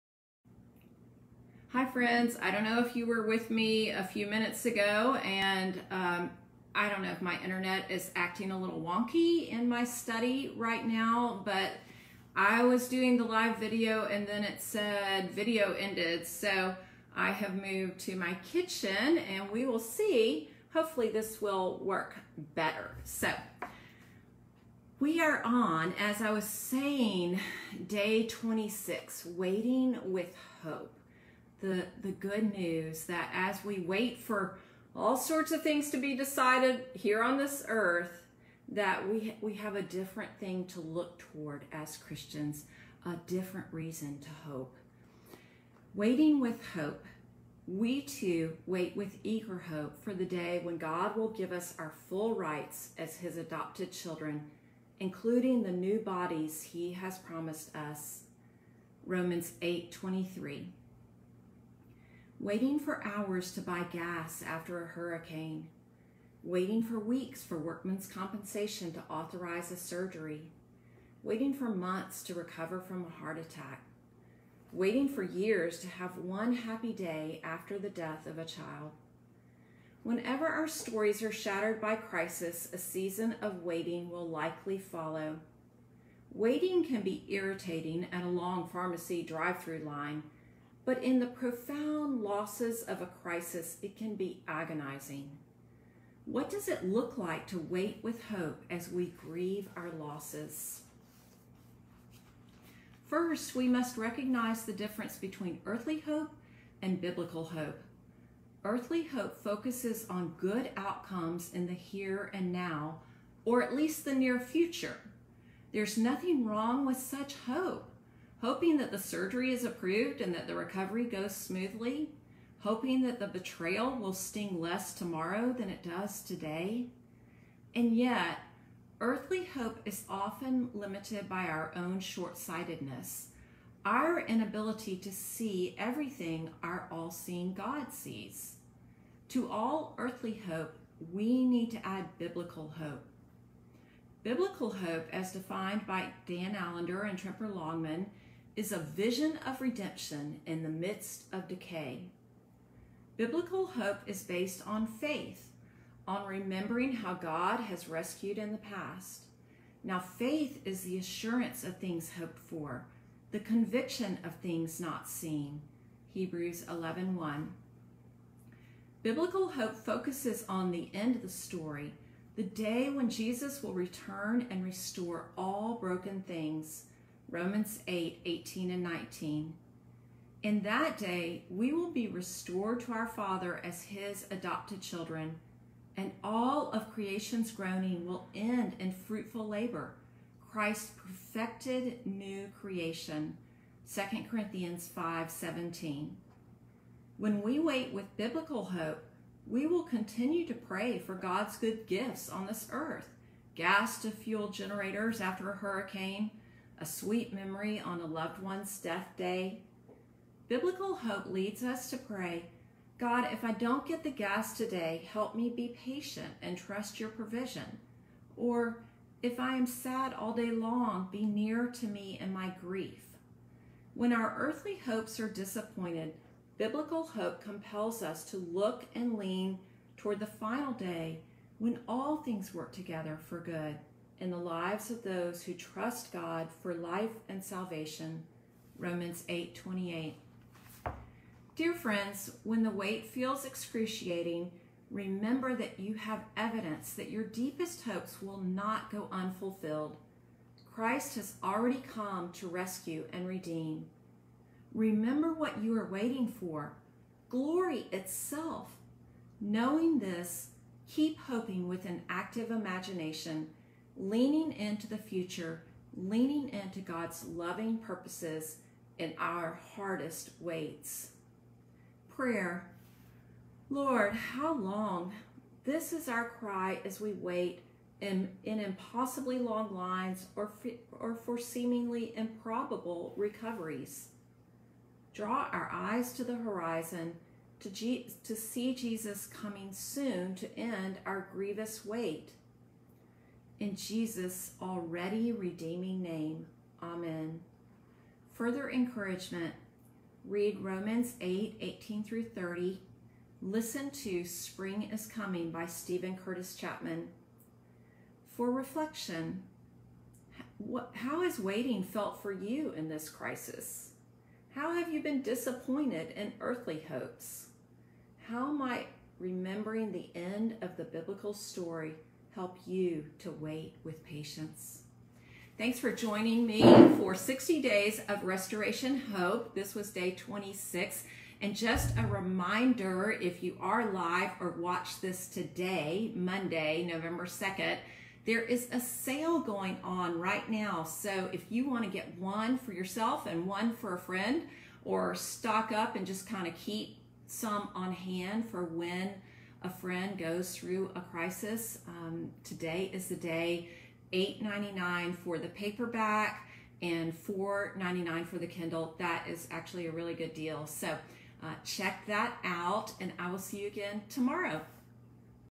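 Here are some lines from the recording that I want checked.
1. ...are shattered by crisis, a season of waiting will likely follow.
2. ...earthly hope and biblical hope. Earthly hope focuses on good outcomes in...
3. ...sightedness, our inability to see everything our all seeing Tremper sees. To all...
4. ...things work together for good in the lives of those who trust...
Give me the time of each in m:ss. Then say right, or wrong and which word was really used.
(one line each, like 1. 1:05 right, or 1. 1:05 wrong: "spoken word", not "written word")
1. 1:21 right
2. 1:45 right
3. 2:12 wrong: "God", not "Tremper"
4. 3:52 right.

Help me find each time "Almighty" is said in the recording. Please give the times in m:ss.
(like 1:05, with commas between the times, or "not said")
not said.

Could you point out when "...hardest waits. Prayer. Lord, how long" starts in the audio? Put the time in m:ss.
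4:29.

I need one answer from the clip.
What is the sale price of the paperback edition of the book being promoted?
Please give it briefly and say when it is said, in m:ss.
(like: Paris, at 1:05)
$8.99, at 5:54.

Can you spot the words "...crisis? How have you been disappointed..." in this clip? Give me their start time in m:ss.
5:13.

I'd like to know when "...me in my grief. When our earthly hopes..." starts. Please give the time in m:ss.
3:41.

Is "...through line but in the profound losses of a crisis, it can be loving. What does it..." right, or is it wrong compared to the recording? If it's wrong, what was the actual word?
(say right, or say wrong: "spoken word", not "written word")
wrong: "agonizing", not "loving".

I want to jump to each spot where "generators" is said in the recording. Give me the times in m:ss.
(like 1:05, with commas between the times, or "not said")
3:24.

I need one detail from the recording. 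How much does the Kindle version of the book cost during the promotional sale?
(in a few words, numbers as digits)
$4.99.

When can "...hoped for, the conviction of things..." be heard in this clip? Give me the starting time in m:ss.
2:42.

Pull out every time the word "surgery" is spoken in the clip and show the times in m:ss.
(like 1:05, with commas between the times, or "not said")
1:09, 1:58.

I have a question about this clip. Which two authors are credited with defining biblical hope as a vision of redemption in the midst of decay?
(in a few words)
Dan Allender and Tremper Longman.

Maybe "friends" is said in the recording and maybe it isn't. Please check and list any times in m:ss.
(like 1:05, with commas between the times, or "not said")
0:01, 4:01, 5:43, 5:49.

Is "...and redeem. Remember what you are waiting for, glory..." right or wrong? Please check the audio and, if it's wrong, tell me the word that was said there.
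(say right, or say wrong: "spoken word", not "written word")
right.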